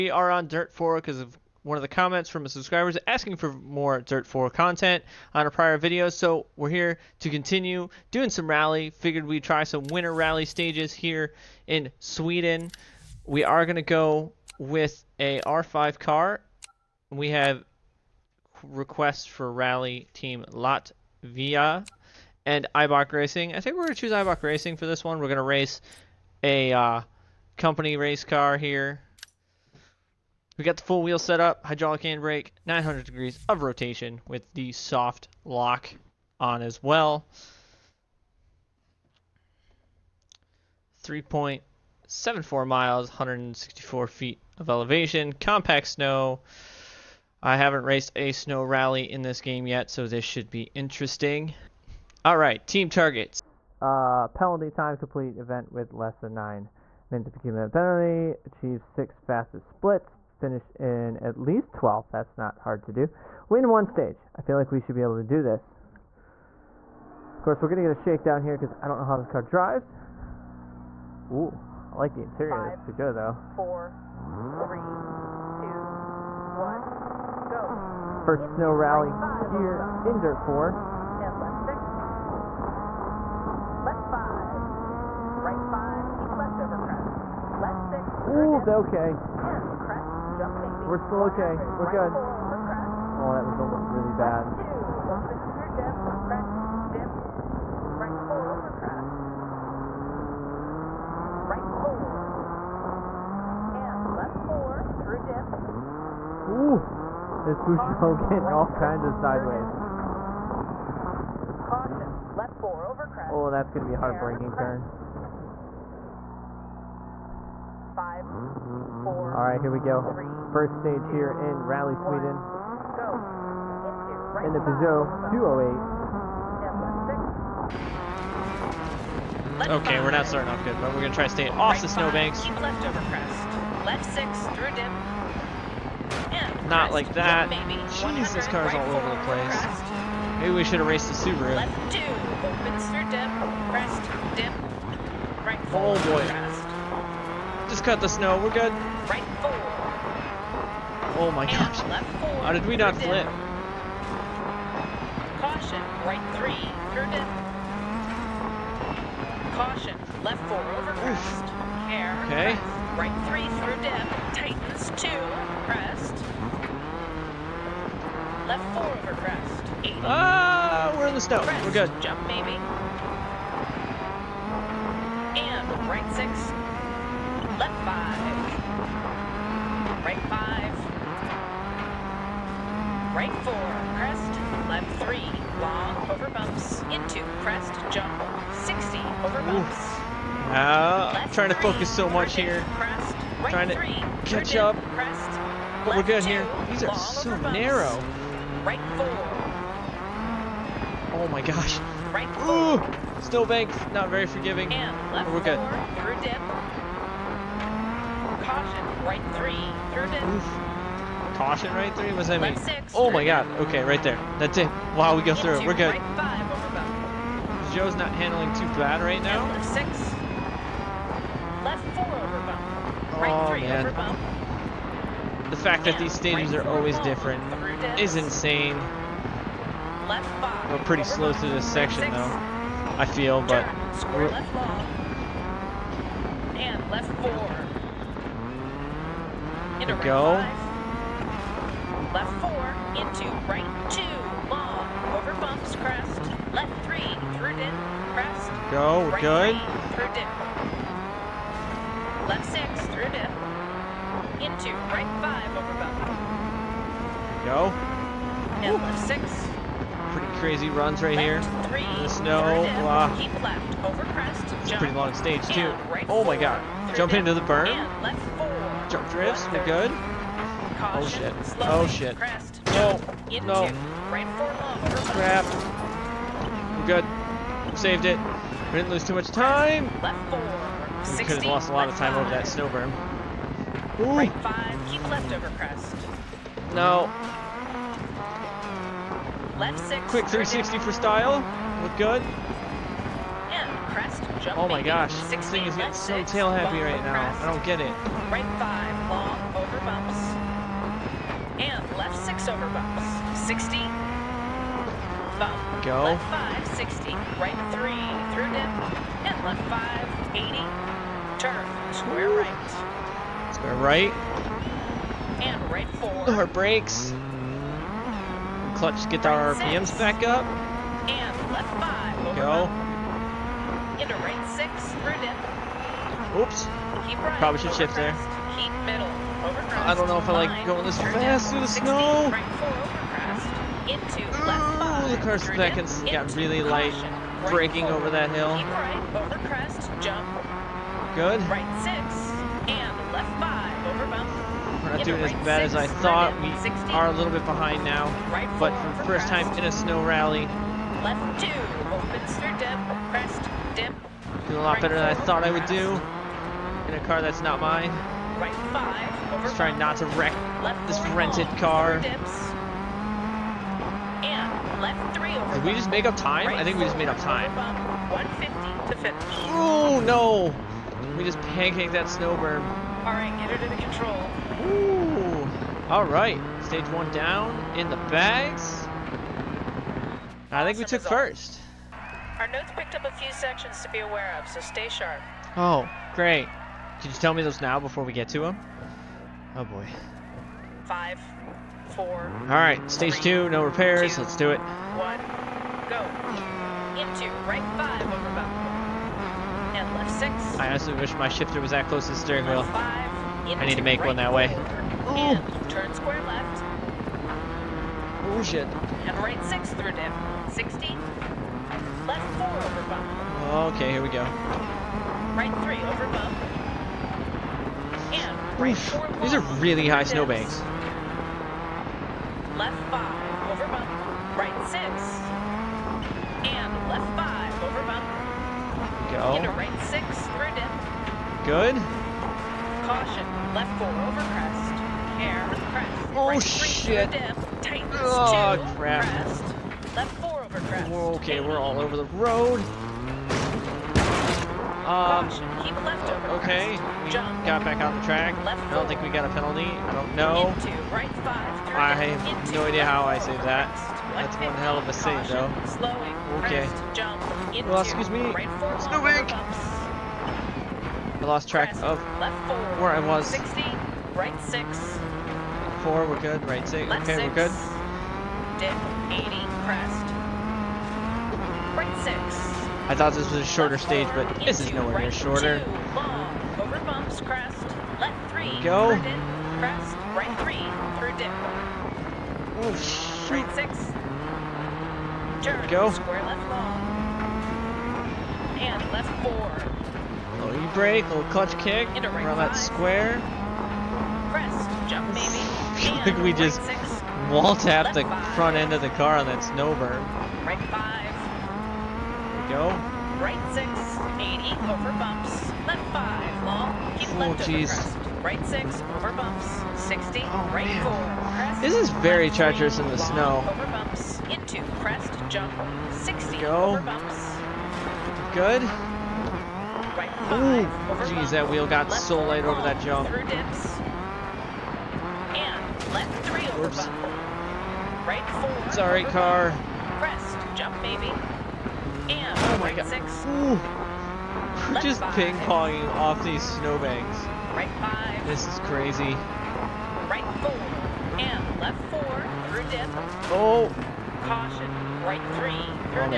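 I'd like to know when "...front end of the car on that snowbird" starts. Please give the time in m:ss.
8:18.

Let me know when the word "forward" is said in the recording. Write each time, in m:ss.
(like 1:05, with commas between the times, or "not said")
5:15.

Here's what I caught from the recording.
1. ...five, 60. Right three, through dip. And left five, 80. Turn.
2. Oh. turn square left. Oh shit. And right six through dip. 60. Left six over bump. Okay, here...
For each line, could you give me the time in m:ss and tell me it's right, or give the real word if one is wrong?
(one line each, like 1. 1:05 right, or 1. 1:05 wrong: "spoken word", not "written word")
1. 5:06 right
2. 6:45 wrong: "four", not "six".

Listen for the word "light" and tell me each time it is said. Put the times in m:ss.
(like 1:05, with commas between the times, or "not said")
5:36, 8:42.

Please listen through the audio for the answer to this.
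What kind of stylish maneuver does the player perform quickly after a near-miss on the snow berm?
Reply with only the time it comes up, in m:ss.
4:50.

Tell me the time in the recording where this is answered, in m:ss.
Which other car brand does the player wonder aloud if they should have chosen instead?
2:21.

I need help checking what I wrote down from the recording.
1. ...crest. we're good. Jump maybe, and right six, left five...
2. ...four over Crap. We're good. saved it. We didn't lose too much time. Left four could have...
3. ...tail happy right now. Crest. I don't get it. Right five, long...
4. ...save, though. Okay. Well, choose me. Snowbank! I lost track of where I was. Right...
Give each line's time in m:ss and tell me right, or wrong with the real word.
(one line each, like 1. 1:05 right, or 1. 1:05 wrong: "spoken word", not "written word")
1. 2:51 right
2. 4:34 right
3. 4:56 right
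4. 7:34 wrong: "excuse", not "choose".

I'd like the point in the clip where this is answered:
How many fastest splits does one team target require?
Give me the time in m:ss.
0:58.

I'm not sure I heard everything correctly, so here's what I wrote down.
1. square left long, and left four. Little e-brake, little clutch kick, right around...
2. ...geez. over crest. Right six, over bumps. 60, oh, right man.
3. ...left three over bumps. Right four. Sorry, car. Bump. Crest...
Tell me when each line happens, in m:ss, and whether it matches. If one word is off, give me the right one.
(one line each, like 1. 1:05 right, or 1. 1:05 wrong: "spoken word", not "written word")
1. 8:05 right
2. 8:27 right
3. 8:45 right.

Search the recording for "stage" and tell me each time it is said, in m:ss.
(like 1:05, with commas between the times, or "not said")
0:10, 1:03, 2:00, 3:46, 4:25, 6:16, 6:32, 7:53.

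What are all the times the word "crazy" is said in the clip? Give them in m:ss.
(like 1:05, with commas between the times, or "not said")
4:20, 8:58.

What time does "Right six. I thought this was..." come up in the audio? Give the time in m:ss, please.
7:51.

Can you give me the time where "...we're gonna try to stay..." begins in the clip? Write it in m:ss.
2:10.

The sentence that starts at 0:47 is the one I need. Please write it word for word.
I haven't raced a snow rally in this game yet, so this should be interesting.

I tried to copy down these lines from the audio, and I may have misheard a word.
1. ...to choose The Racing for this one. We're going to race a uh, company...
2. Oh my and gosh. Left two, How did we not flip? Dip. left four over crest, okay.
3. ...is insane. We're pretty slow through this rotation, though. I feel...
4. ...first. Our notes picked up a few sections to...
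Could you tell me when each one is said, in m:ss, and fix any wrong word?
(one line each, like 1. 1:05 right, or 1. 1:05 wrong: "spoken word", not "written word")
1. 0:23 wrong: "Eibach", not "The"
2. 2:31 wrong: "four", not "two"
3. 3:47 wrong: "section", not "rotation"
4. 6:21 right.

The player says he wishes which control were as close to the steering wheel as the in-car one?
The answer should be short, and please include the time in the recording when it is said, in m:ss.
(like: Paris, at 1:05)
shifter, at 6:41.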